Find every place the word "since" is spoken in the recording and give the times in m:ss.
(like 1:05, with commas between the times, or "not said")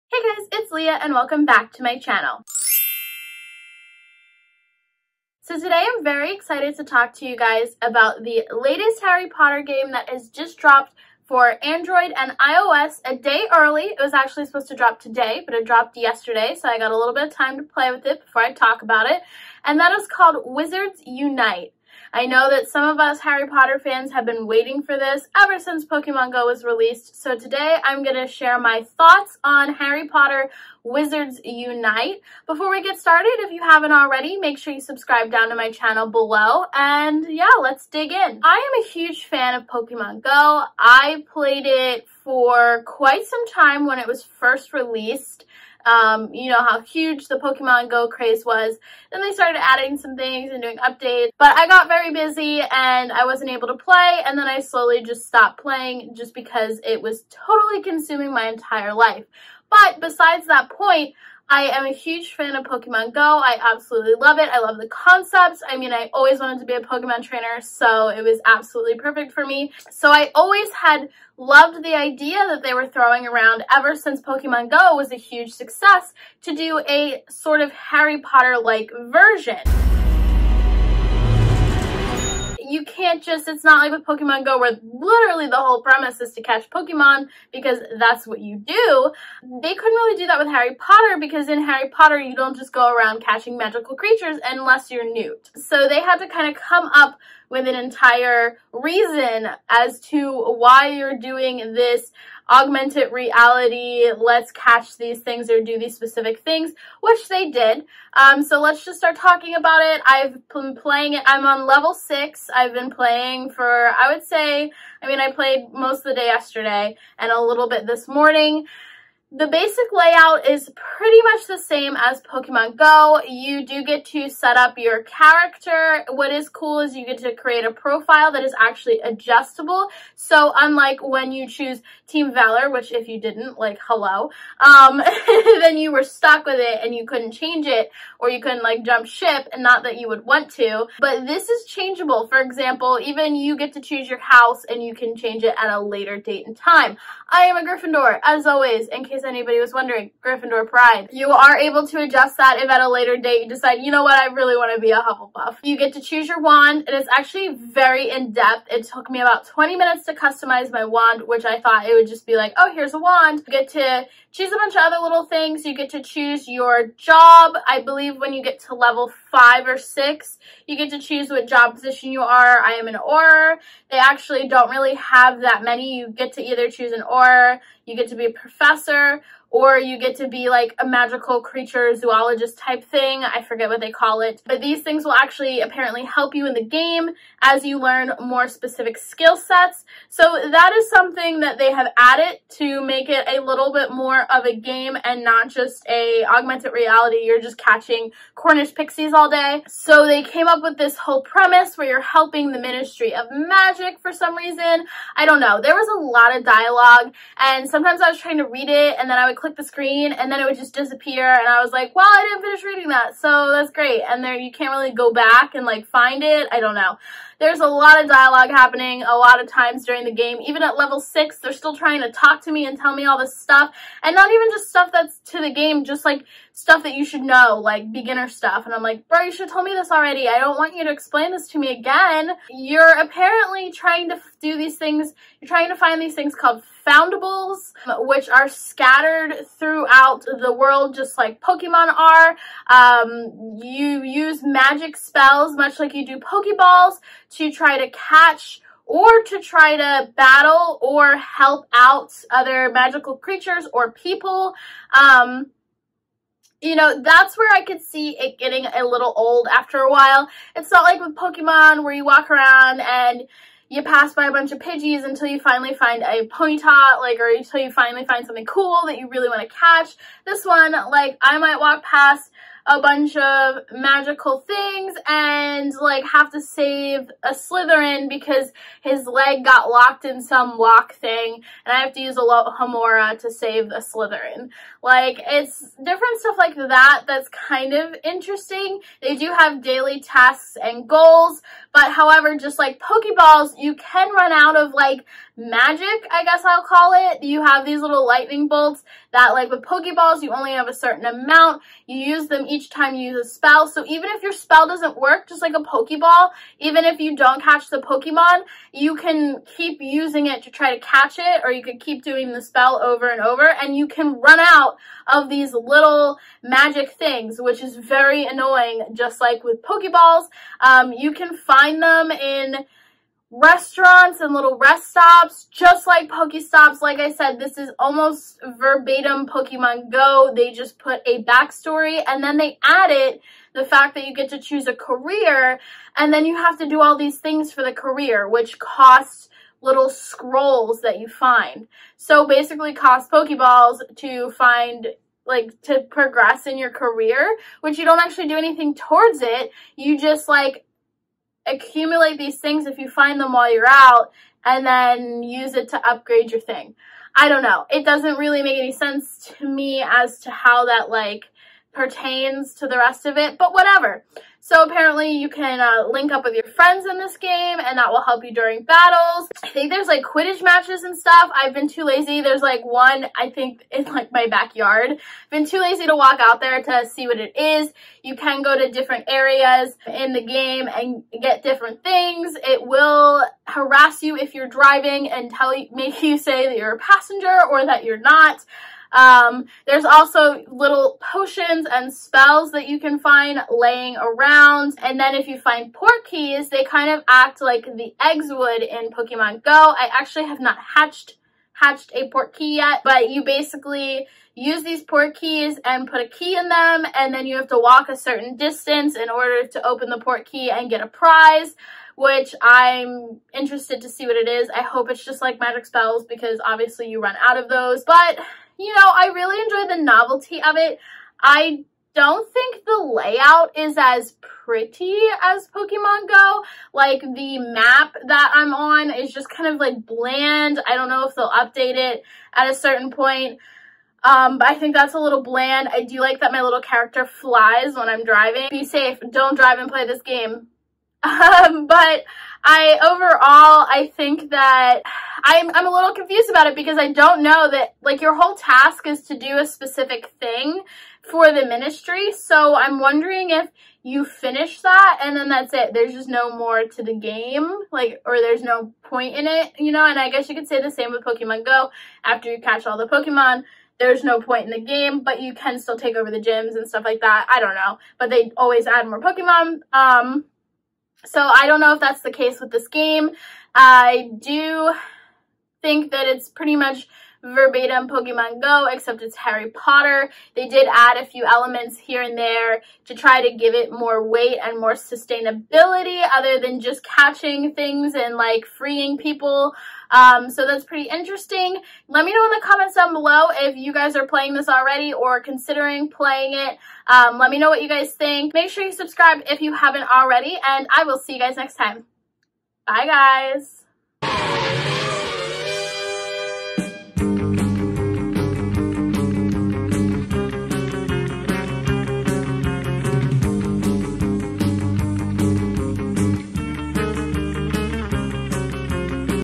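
0:25, 1:13.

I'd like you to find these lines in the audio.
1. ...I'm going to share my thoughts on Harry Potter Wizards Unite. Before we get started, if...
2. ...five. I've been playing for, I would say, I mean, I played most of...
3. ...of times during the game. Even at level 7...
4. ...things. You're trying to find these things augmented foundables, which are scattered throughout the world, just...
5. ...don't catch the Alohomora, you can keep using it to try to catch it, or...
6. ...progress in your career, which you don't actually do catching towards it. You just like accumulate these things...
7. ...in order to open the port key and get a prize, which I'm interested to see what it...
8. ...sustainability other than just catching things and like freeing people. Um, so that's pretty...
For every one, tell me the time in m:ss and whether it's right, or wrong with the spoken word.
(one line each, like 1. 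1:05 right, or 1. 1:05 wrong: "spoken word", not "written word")
1. 0:27 right
2. 1:51 wrong: "six", not "five"
3. 3:39 wrong: "6", not "7"
4. 3:54 wrong: "called", not "augmented"
5. 5:07 wrong: "Pokemon", not "Alohomora"
6. 5:45 wrong: "anything", not "catching"
7. 6:48 right
8. 8:04 right.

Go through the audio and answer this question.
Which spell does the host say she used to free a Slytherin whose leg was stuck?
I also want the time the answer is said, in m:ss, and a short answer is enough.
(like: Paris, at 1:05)
Alohomora, at 4:42.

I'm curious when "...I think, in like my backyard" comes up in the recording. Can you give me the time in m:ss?
6:13.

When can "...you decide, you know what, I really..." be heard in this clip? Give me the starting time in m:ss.
2:33.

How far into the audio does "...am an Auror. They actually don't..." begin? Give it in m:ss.
2:52.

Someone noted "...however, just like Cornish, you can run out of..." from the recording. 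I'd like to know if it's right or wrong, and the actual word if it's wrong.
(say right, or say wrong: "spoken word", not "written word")
wrong: "Pokeballs", not "Cornish".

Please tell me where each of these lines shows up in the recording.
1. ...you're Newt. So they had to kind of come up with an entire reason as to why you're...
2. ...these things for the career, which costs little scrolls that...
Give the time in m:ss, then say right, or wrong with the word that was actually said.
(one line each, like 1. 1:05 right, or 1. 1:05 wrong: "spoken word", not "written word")
1. 1:34 right
2. 5:36 right.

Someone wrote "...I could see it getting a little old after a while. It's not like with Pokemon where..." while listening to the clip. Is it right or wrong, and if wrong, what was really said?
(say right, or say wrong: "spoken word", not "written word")
right.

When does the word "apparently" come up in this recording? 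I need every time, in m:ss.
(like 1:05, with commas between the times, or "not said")
3:05, 3:52, 6:04.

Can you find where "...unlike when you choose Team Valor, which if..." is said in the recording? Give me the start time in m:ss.
2:10.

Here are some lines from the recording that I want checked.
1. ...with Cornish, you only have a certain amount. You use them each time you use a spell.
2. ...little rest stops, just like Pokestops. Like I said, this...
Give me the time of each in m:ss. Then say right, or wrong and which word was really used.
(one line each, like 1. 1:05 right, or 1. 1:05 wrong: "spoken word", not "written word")
1. 4:59 wrong: "Pokeballs", not "Cornish"
2. 5:24 right.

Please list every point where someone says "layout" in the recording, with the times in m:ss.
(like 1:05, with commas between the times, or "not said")
1:59, 7:02.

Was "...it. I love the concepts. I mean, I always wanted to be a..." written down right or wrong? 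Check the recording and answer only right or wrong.
right.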